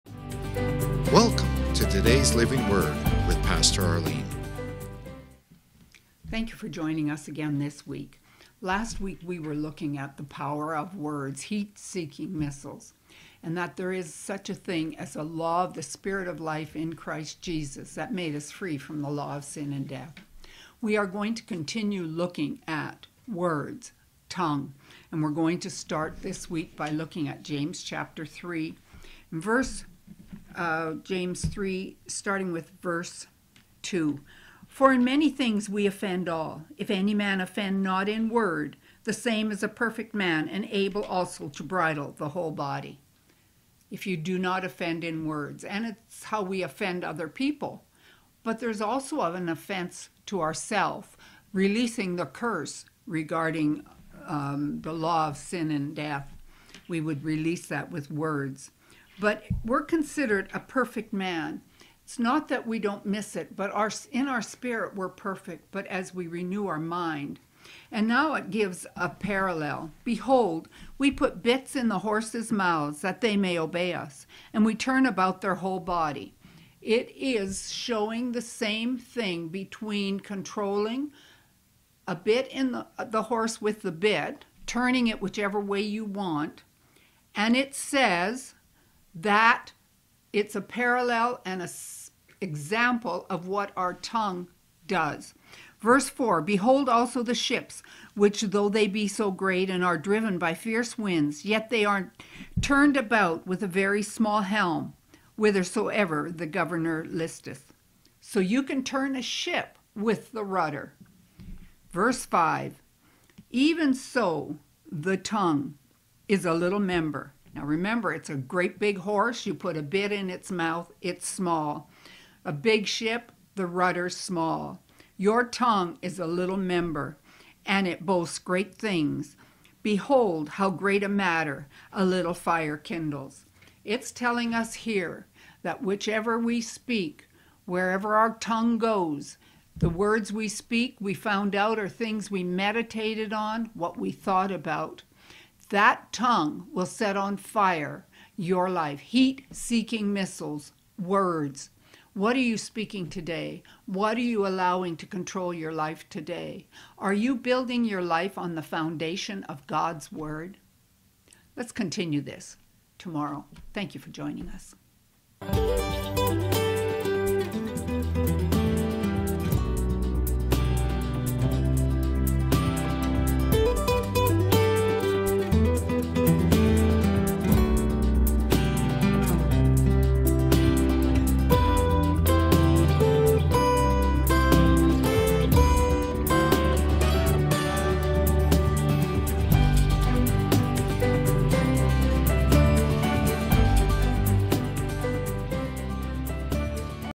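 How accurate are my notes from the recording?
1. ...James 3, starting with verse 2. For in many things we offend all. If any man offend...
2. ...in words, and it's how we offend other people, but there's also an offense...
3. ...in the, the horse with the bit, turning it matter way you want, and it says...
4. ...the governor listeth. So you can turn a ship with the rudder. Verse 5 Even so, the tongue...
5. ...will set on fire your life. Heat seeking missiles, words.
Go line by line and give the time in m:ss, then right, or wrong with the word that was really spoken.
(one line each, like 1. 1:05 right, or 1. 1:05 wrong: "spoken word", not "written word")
1. 0:31 right
2. 0:45 right
3. 1:22 wrong: "whichever", not "matter"
4. 1:46 right
5. 2:26 right.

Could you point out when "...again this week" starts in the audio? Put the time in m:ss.
0:07.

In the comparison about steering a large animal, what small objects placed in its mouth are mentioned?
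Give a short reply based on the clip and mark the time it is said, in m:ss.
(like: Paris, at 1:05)
bits, at 1:11.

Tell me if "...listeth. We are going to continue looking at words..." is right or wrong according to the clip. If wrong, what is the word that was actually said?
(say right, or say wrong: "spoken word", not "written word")
wrong: "death", not "listeth".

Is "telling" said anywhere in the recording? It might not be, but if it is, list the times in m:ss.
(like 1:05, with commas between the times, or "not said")
2:14.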